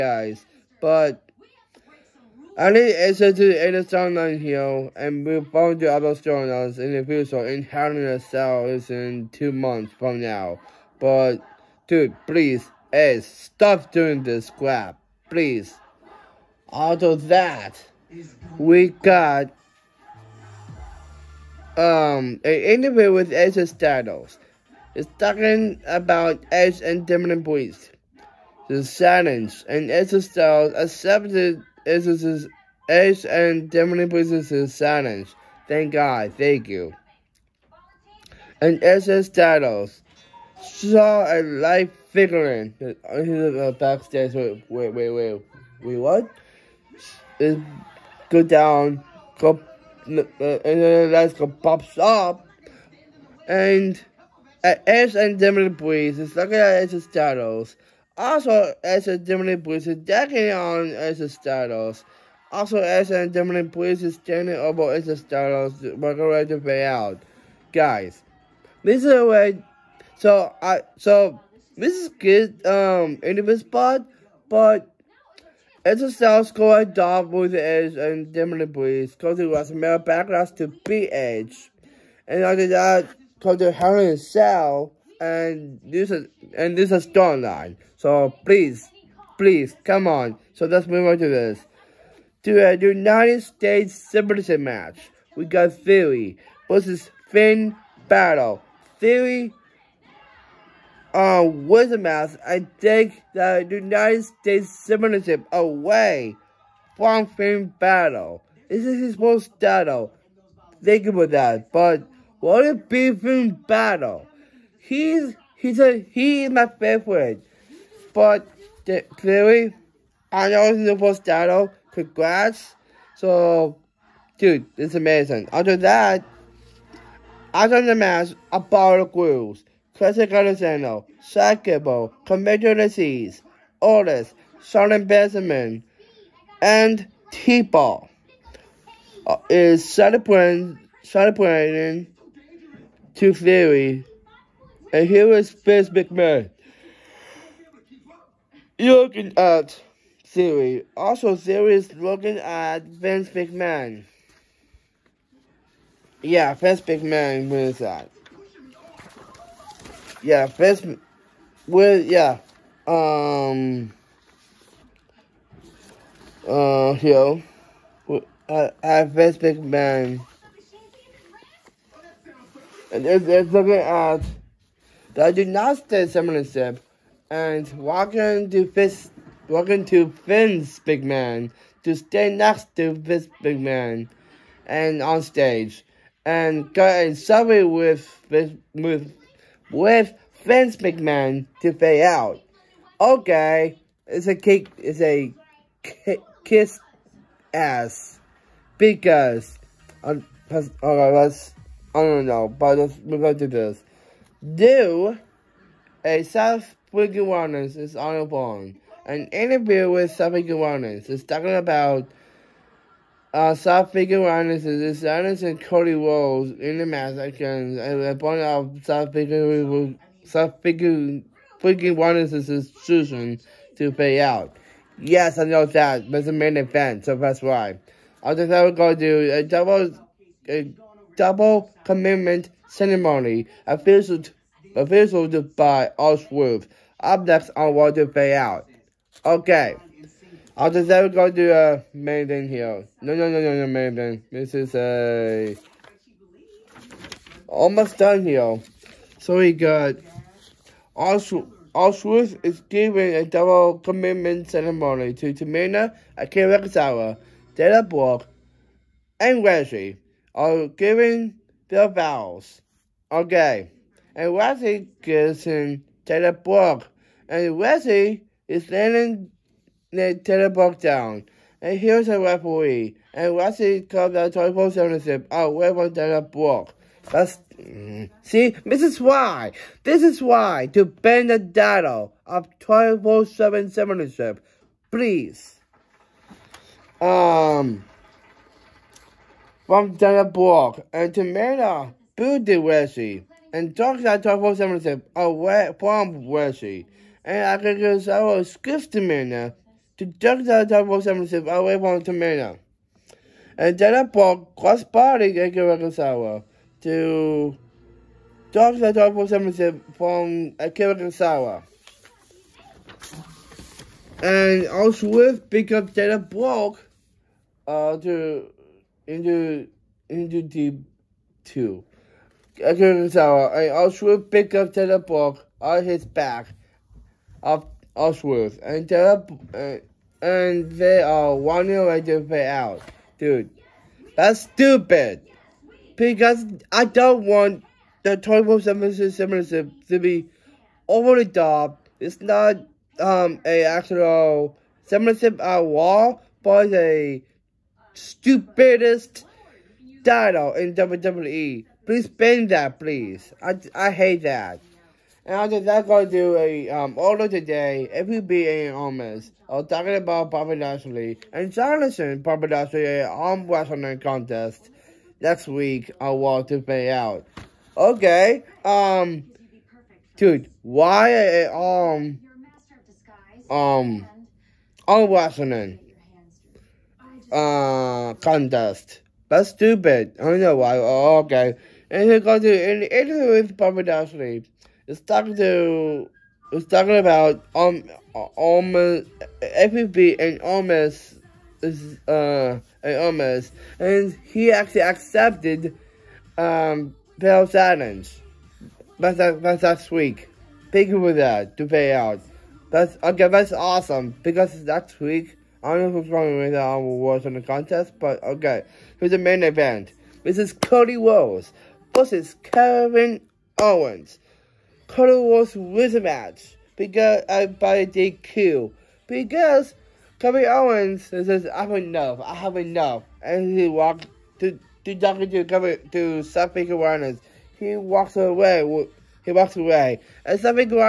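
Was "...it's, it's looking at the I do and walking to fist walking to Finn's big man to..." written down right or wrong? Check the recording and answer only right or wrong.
right.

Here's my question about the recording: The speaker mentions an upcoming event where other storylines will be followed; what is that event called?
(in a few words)
Hell in a Cell.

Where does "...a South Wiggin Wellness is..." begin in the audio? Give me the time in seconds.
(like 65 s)
206 s.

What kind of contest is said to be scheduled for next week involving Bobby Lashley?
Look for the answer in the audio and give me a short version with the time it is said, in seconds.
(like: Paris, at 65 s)
arm wrestling contest, at 363 s.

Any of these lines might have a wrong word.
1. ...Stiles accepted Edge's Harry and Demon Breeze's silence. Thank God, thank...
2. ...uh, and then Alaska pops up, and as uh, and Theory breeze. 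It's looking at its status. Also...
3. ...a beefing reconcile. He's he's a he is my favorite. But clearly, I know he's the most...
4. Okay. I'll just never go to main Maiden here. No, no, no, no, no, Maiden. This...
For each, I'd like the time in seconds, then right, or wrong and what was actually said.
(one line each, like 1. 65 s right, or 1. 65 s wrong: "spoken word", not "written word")
1. 30 s wrong: "Edge", not "Harry"
2. 50 s wrong: "Demon", not "Theory"
3. 112 s wrong: "battle", not "reconcile"
4. 239 s right.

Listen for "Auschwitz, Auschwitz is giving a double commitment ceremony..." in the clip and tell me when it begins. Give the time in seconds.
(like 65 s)
250 s.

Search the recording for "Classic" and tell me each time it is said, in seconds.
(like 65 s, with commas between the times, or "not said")
129 s.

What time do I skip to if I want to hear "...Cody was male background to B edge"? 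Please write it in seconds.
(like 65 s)
79 s.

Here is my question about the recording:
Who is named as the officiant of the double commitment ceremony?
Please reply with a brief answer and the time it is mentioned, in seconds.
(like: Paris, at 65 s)
Ellsworth, at 235 s.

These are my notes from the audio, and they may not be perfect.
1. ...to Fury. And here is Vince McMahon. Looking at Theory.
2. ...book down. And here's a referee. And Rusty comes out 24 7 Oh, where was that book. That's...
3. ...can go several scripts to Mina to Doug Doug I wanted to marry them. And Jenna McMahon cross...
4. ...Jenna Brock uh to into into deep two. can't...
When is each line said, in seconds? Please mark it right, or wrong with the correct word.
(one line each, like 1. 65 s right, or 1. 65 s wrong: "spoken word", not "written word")
1. 143 s right
2. 270 s right
3. 297 s wrong: "Paul", not "McMahon"
4. 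315 s right.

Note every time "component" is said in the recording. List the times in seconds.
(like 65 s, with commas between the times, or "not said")
not said.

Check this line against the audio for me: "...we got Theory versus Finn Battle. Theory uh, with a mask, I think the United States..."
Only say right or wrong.
right.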